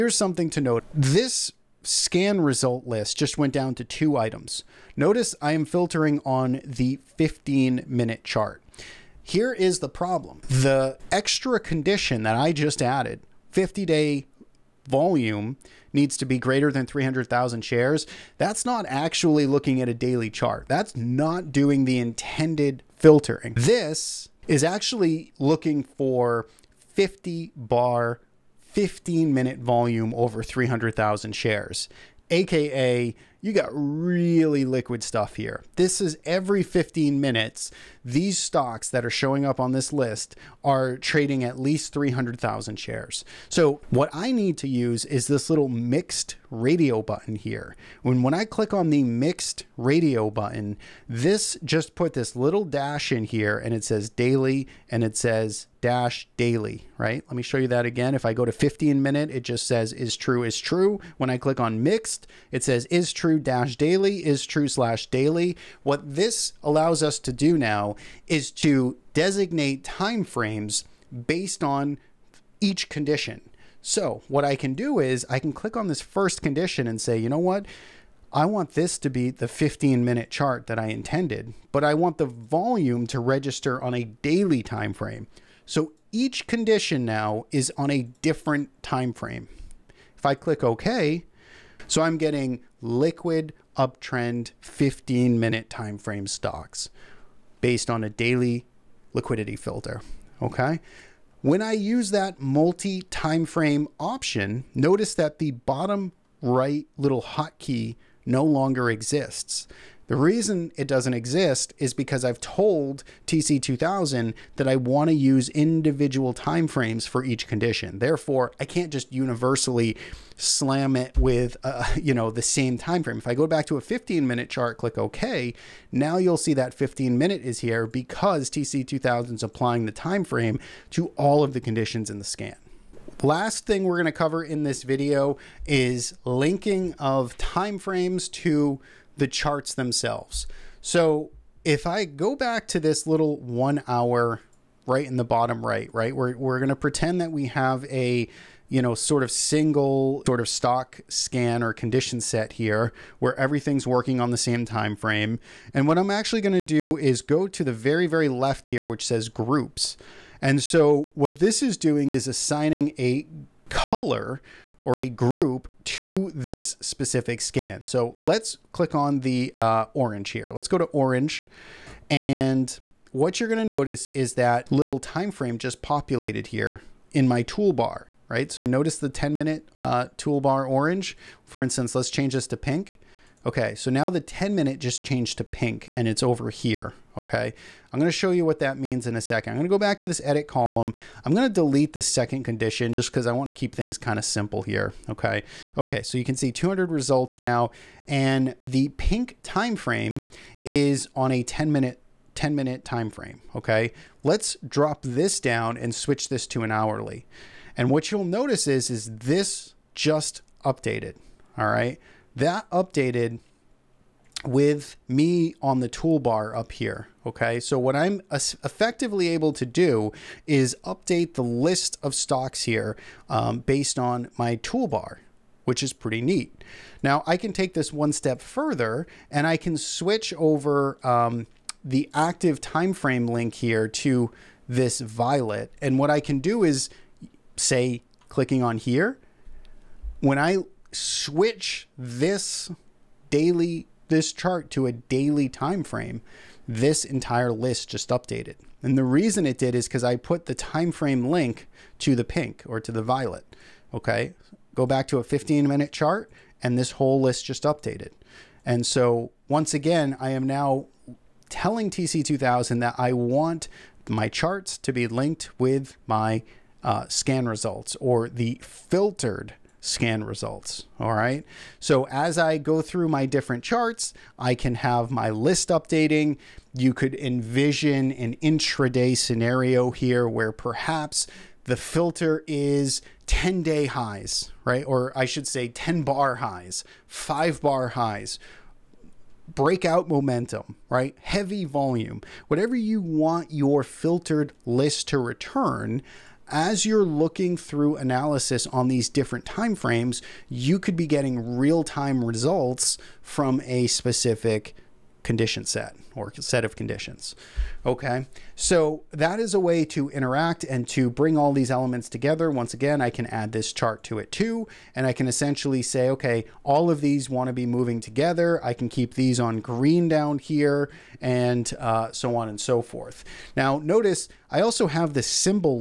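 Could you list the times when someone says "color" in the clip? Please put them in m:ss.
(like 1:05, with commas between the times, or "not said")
2:43.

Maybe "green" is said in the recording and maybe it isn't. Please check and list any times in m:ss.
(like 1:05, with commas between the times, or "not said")
5:19.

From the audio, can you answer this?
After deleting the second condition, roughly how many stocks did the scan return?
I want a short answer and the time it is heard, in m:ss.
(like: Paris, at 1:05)
200, at 3:16.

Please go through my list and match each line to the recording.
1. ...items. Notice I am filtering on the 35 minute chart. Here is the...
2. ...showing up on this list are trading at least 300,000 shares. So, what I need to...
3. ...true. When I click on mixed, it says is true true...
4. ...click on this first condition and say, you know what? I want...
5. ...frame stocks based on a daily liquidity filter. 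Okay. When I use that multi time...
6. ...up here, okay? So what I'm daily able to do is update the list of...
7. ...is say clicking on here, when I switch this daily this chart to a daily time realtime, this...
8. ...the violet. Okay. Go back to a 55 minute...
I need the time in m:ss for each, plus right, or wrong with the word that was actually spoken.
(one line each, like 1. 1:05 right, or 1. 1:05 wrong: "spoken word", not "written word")
1. 0:04 wrong: "15", not "35"
2. 0:39 right
3. 1:00 right
4. 1:15 right
5. 1:35 right
6. 3:36 wrong: "effectively", not "daily"
7. 3:56 wrong: "frame", not "realtime"
8. 4:12 wrong: "15", not "55".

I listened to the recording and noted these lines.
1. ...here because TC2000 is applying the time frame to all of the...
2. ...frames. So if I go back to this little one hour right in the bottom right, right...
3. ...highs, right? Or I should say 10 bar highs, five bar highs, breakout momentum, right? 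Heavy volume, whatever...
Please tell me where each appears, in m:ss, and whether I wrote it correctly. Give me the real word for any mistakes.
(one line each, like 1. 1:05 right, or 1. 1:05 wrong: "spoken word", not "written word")
1. 2:07 right
2. 2:19 wrong: "themselves", not "frames"
3. 4:43 right.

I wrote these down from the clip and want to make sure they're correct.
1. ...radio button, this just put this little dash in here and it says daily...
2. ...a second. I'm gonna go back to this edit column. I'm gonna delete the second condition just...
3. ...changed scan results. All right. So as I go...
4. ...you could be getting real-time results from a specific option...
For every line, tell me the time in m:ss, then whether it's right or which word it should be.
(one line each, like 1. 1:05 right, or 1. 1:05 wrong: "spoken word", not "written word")
1. 0:49 right
2. 3:09 right
3. 4:28 wrong: "filtered", not "changed"
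4. 5:00 wrong: "condition", not "option".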